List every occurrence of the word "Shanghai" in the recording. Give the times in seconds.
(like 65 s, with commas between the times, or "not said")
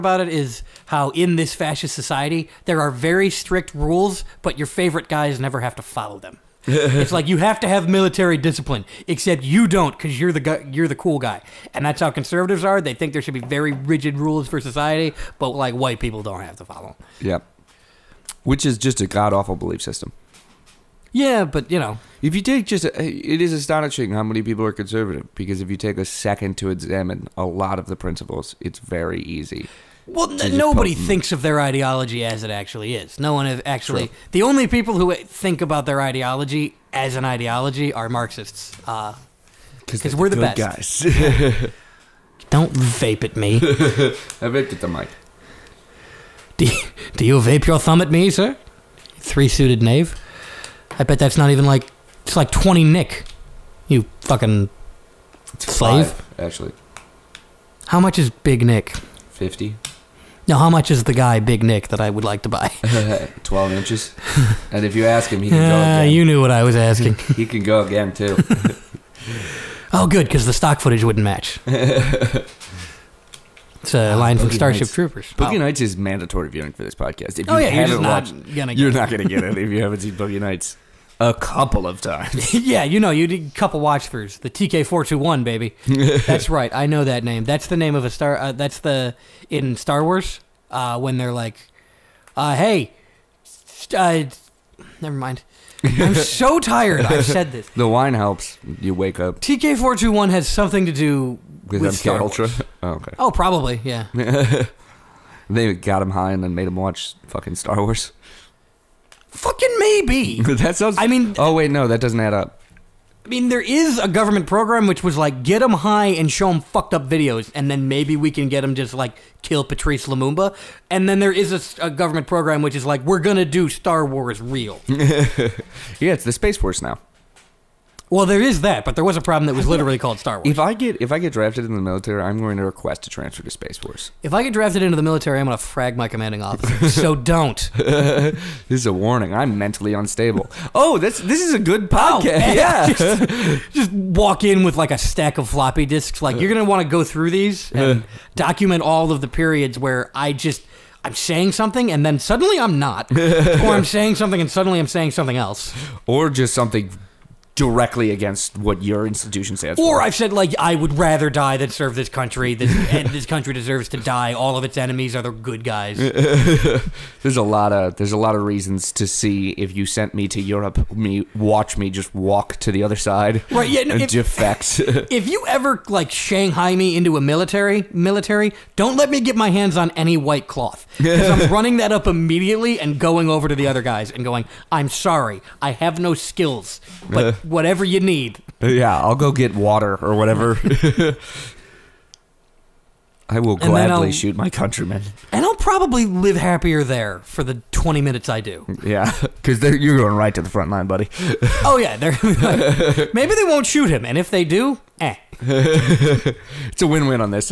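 176 s.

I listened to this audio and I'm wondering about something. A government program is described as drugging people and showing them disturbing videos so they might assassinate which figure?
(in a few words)
Patrice Lumumba.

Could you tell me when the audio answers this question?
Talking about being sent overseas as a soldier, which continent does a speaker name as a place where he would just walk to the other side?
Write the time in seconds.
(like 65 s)
170 s.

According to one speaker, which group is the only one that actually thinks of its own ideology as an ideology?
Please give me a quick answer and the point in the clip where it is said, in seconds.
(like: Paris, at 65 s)
Marxists, at 38 s.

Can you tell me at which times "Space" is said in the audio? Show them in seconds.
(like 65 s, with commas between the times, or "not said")
126 s, 133 s.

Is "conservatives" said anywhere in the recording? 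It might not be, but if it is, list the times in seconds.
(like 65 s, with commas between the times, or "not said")
12 s, 24 s.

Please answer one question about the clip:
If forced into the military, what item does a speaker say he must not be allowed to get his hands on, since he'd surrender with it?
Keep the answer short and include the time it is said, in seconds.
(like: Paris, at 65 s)
white cloth, at 180 s.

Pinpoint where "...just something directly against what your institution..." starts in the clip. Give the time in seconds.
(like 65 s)
156 s.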